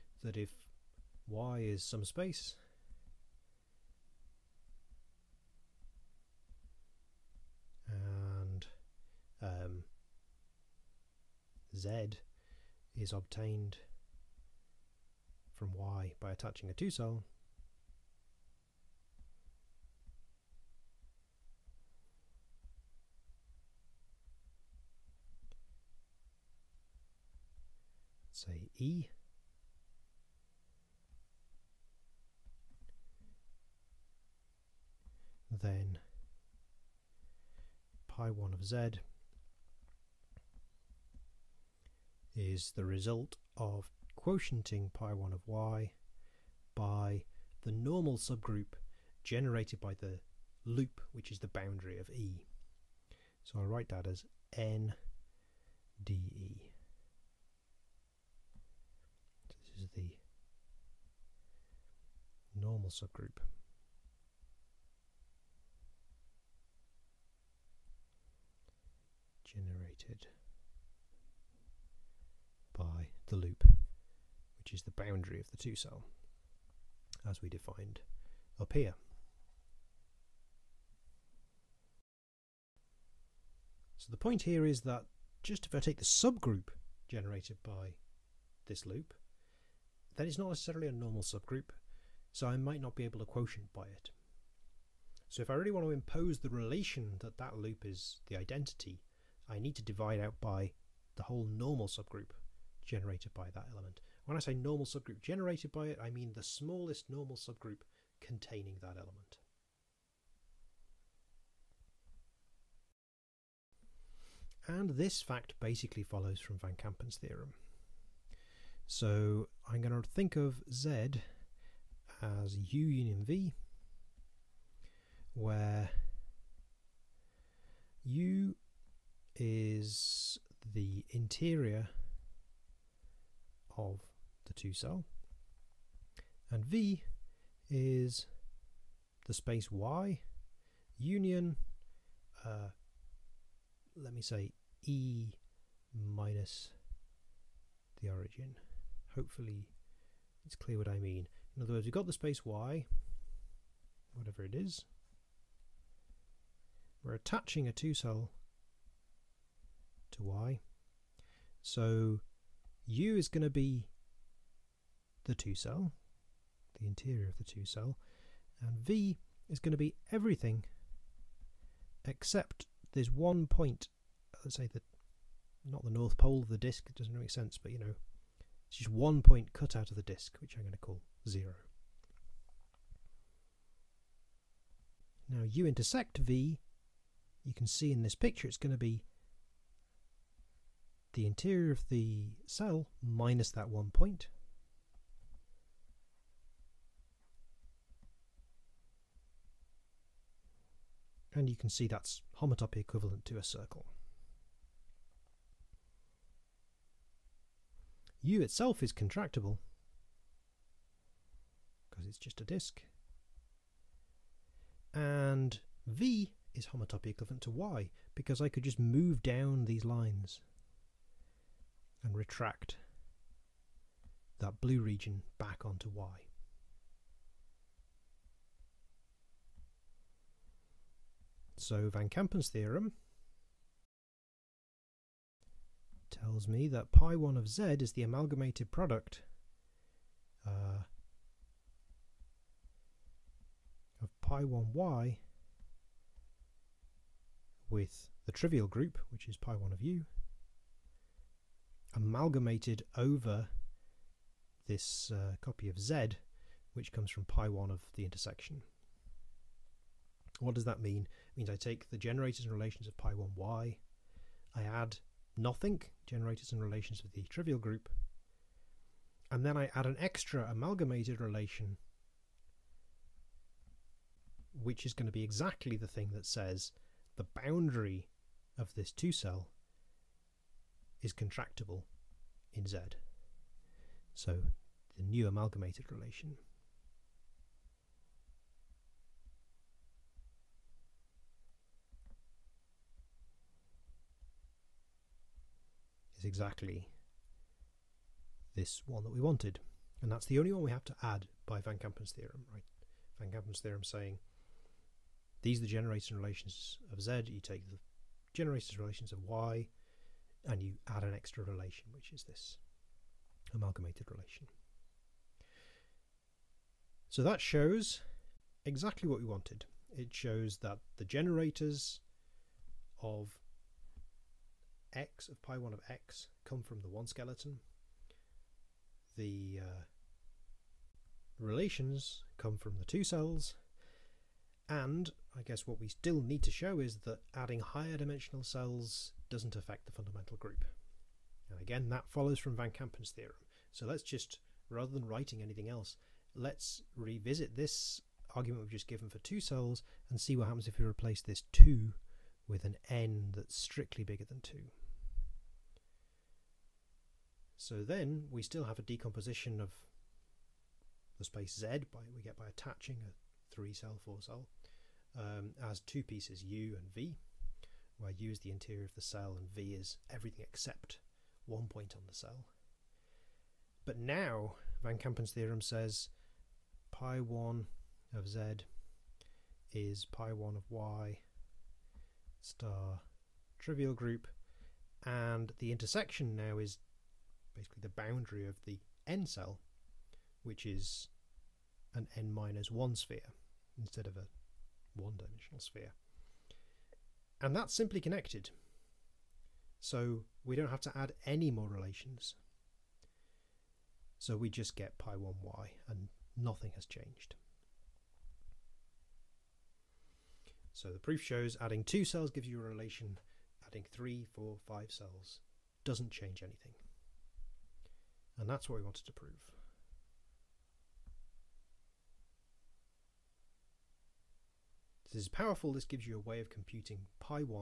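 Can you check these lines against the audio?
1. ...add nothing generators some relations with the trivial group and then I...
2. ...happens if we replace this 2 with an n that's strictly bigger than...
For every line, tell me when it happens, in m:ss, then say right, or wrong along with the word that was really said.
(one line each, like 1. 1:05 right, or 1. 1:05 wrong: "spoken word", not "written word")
1. 4:24 right
2. 5:50 right.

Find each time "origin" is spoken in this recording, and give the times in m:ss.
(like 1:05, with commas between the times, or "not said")
2:28.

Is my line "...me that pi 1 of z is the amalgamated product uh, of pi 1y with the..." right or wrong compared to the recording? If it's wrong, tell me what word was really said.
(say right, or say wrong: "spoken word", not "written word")
right.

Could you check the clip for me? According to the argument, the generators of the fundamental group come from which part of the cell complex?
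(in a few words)
The one skeleton.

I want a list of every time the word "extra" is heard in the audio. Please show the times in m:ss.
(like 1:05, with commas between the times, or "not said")
4:29, 5:11.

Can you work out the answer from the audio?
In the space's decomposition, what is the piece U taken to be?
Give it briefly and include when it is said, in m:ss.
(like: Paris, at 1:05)
The interior of the two-cell, at 2:10.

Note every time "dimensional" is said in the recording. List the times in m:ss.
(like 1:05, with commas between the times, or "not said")
5:37, 6:35.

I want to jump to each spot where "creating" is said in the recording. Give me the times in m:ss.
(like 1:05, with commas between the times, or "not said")
not said.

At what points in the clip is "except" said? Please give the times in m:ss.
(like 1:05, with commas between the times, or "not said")
2:52, 6:10.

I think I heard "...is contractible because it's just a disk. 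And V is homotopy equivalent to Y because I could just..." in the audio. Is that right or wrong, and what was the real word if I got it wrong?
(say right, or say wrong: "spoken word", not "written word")
right.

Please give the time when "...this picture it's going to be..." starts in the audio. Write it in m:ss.
3:08.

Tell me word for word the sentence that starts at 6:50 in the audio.
So the proof shows adding two cells gives you a relation, adding three, four, five cells doesn't change anything.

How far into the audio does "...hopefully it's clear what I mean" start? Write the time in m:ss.
2:29.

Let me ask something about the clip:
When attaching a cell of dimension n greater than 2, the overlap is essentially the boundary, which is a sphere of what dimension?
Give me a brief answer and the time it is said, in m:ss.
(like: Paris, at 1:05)
n minus 1, at 6:32.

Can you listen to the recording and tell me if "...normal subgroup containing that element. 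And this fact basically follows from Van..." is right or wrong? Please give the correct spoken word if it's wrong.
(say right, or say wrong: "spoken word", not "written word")
right.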